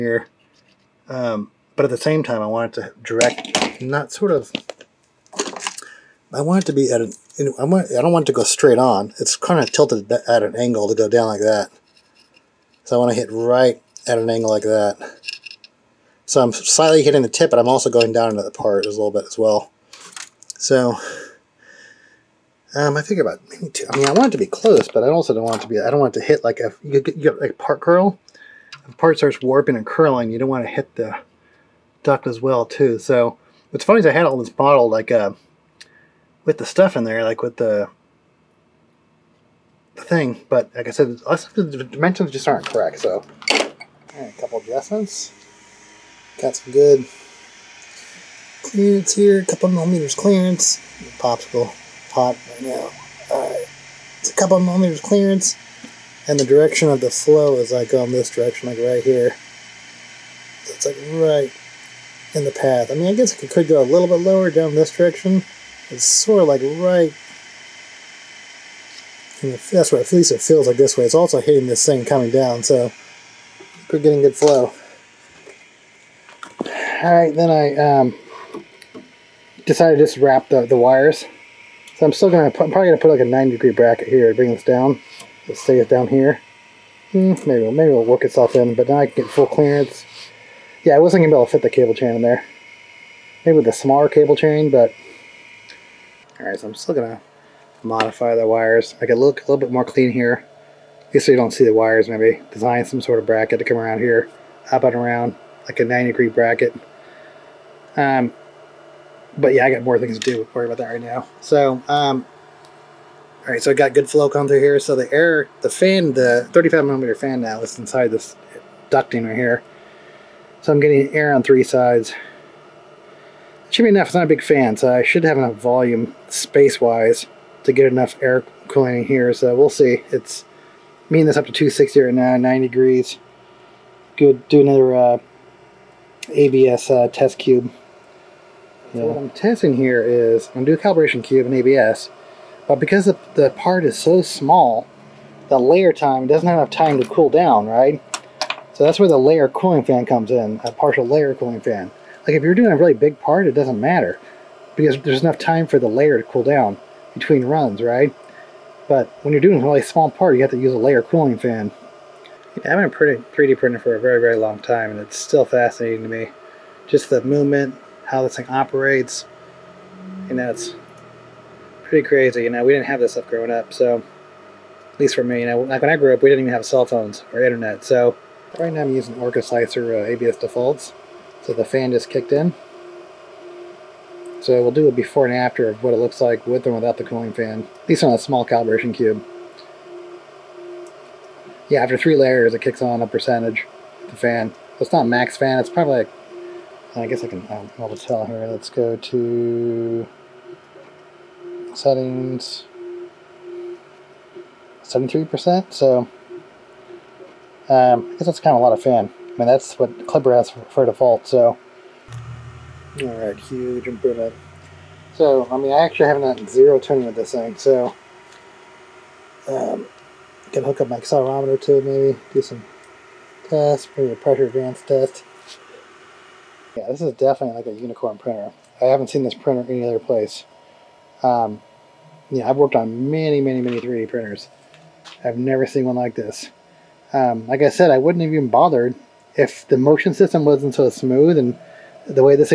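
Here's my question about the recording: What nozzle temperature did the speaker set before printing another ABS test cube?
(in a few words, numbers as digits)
260.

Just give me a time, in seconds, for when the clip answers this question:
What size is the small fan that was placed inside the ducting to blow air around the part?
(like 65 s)
116 s.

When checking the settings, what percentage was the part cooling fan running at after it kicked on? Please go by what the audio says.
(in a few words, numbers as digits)
73%.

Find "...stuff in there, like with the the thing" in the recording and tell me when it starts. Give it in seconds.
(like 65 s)
36 s.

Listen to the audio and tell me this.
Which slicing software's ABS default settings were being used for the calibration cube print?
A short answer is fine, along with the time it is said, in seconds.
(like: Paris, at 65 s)
Orca Slicer, at 179 s.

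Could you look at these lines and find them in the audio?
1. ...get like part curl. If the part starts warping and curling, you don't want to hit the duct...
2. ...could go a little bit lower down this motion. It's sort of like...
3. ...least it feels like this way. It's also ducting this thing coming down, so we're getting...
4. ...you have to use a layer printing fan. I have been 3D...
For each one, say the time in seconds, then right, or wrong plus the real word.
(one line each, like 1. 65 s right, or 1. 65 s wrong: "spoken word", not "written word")
1. 27 s right
2. 63 s wrong: "direction", not "motion"
3. 70 s wrong: "hitting", not "ducting"
4. 160 s wrong: "cooling", not "printing".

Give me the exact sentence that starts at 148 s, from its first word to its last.
So that's where the layer cooling fan comes in, a partial layer cooling fan.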